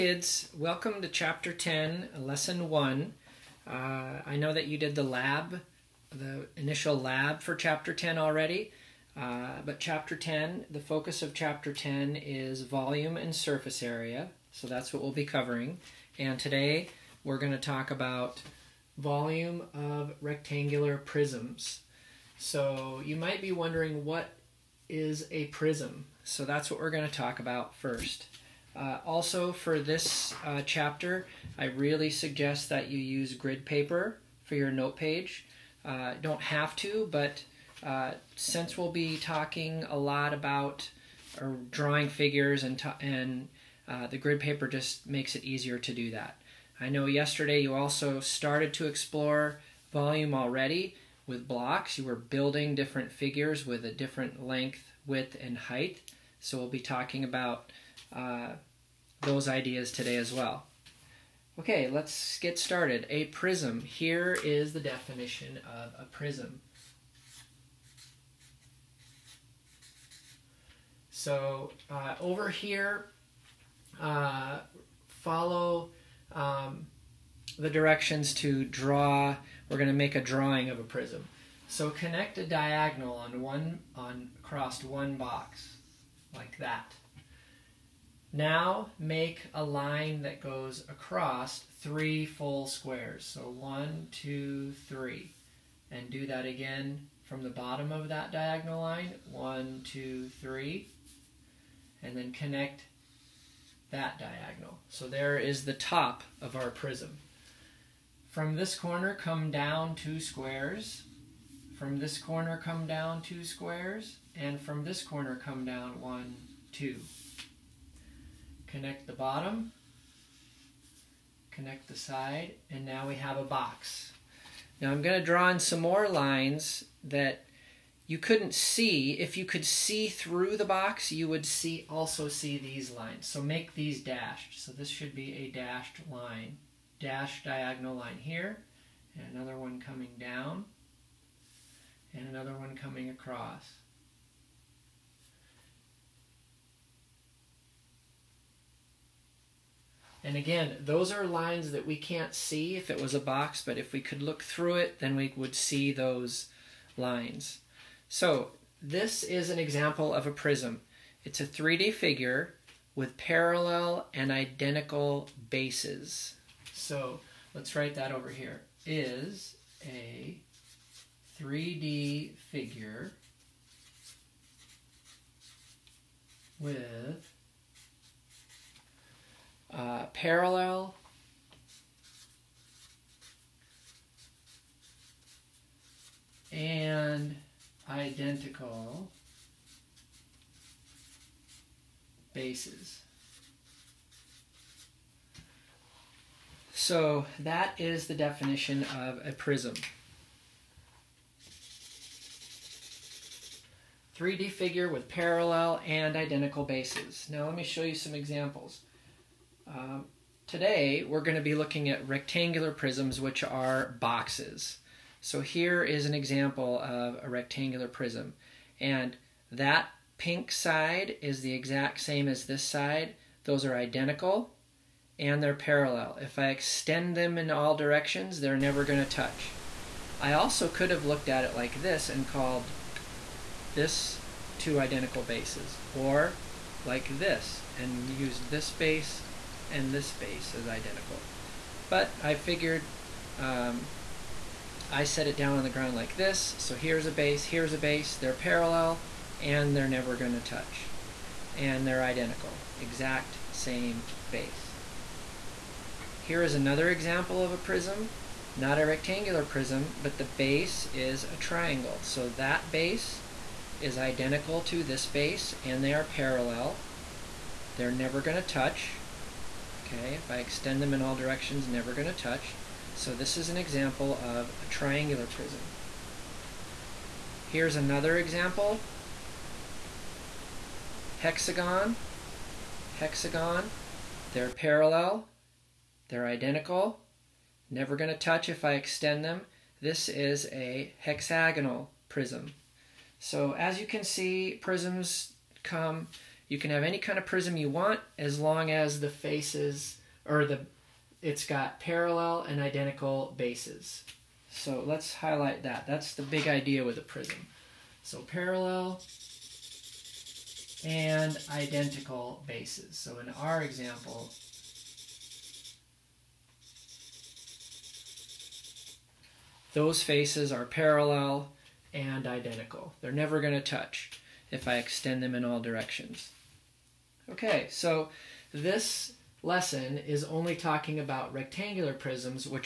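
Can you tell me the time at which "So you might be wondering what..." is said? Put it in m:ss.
0:22.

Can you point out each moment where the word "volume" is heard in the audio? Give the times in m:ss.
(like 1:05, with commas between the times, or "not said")
0:12, 0:18, 0:49.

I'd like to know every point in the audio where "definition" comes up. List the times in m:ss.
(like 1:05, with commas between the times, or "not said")
1:04, 3:18.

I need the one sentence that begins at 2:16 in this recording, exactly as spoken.
Dashed diagonal line here, and another one coming down, and another one coming across.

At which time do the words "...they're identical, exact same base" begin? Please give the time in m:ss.
4:11.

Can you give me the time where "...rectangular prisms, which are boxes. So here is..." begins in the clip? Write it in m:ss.
3:32.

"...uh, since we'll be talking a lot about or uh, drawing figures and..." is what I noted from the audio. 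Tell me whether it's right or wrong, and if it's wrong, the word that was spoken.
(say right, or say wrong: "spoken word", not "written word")
right.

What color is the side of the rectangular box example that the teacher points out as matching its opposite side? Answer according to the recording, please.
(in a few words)
pink.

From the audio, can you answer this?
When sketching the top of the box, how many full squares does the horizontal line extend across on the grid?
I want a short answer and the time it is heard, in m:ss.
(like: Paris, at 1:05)
3, at 1:31.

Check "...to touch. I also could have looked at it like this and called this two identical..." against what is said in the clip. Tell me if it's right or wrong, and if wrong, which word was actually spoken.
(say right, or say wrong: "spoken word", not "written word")
right.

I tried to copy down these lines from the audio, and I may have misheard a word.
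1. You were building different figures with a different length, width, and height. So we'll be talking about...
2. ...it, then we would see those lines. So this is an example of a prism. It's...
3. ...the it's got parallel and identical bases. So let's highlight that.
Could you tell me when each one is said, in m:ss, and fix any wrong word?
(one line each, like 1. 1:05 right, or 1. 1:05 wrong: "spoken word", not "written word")
1. 0:51 right
2. 2:34 right
3. 5:00 right.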